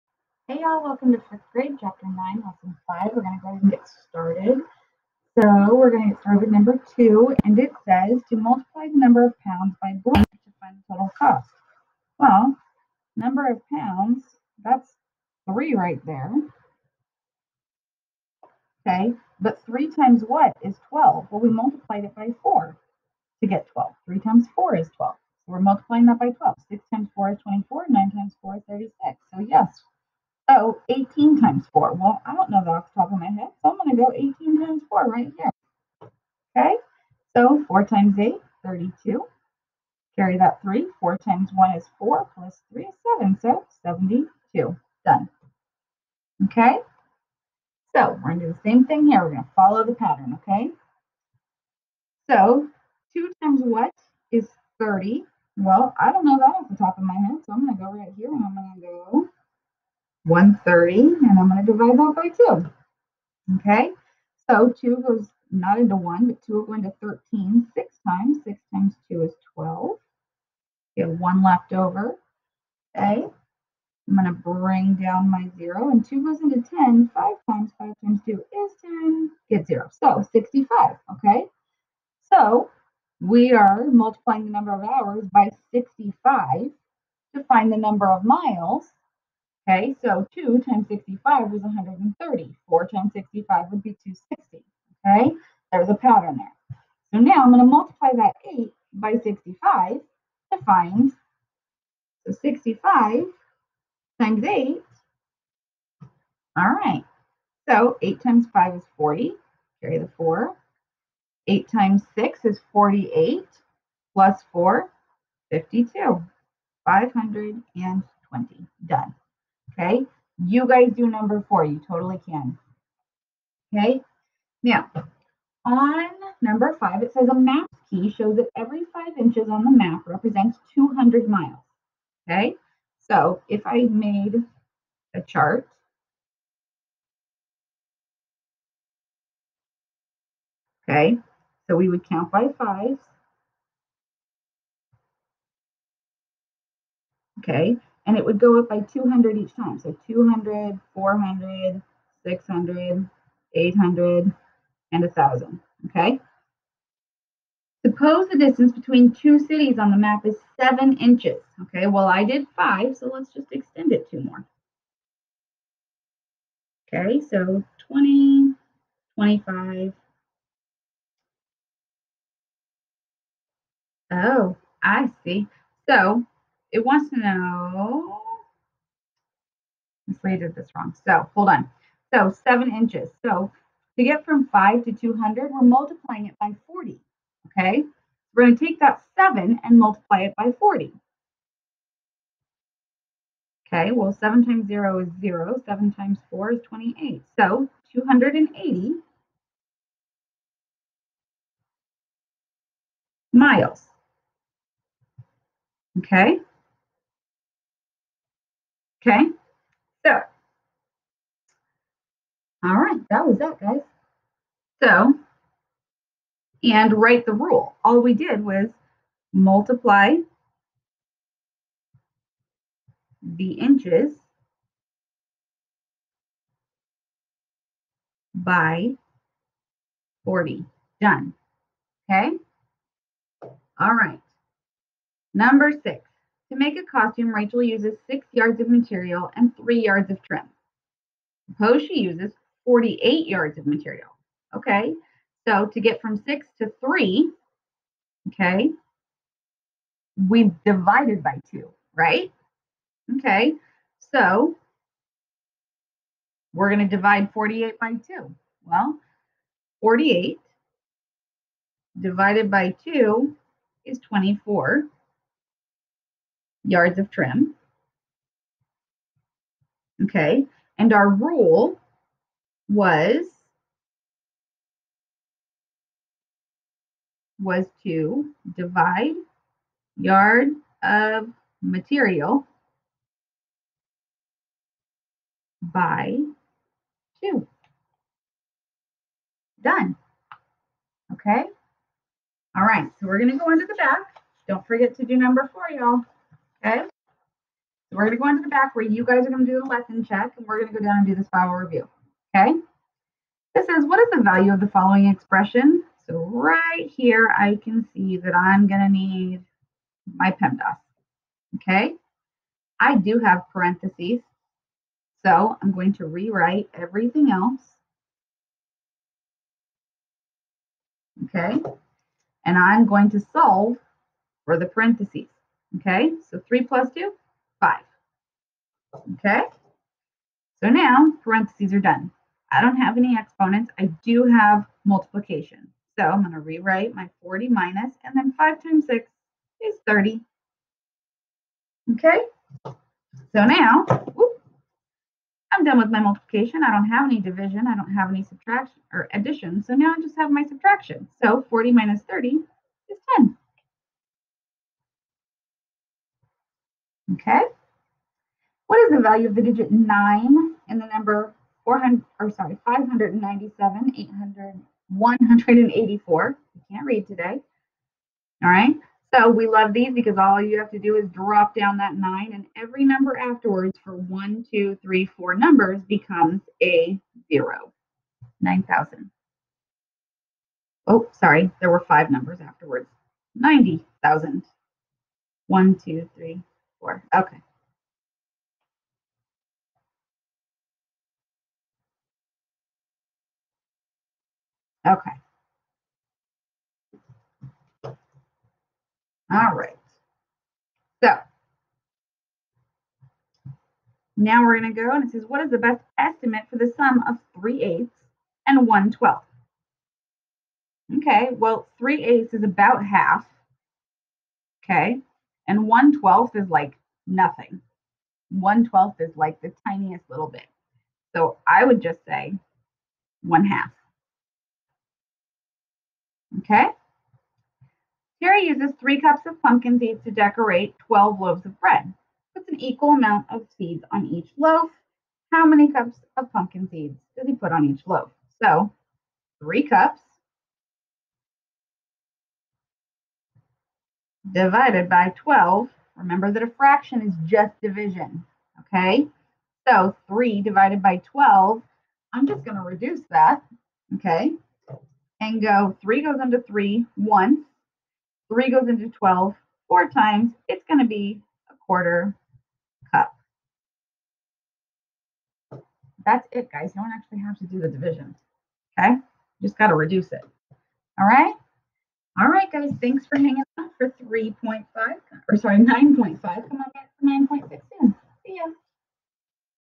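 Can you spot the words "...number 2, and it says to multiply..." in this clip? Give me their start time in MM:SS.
00:06.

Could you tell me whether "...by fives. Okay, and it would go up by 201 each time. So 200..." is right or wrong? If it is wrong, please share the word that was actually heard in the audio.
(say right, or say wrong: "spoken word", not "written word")
wrong: "200", not "201".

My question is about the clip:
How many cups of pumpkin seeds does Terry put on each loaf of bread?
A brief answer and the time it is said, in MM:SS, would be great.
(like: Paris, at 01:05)
a quarter cup, at 07:41.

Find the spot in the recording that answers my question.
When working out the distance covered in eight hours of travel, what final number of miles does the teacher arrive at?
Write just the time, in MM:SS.
01:56.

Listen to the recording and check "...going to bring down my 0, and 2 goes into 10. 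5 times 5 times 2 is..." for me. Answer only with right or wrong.
right.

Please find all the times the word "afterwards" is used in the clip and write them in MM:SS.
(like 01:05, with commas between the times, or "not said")
06:13, 06:22.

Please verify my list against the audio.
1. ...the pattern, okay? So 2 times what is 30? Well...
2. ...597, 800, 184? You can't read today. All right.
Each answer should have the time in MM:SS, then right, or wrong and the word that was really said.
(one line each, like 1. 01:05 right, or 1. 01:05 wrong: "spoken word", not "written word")
1. 00:49 right
2. 06:02 right.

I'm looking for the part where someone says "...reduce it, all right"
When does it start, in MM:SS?
07:49.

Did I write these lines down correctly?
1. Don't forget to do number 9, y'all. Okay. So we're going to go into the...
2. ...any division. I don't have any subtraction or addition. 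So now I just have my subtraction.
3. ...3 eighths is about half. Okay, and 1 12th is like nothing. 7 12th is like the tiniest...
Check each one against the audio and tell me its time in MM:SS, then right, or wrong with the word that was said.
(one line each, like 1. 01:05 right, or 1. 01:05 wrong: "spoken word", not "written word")
1. 04:54 wrong: "4", not "9"
2. 05:47 right
3. 06:51 wrong: "1", not "7".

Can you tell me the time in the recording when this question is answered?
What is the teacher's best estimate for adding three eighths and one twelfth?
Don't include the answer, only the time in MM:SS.
07:03.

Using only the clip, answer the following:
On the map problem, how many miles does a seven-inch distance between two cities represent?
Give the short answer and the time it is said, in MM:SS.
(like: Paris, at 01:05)
280 miles, at 03:17.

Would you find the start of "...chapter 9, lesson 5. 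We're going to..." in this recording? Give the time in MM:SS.
00:01.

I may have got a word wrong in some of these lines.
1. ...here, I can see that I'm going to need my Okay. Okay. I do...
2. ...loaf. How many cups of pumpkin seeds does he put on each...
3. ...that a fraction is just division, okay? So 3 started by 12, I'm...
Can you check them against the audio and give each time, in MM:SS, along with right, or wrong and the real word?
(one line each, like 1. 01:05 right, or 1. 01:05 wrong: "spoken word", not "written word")
1. 05:06 wrong: "PEMDAS", not "Okay"
2. 07:14 right
3. 07:26 wrong: "divided", not "started".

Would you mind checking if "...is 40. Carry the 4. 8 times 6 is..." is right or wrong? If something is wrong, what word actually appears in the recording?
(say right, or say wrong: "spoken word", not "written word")
right.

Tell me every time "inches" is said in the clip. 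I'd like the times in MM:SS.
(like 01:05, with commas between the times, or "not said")
02:09, 02:40, 03:02, 03:43.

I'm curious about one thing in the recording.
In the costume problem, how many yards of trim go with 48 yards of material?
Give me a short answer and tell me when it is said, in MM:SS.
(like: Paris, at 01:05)
24, at 04:23.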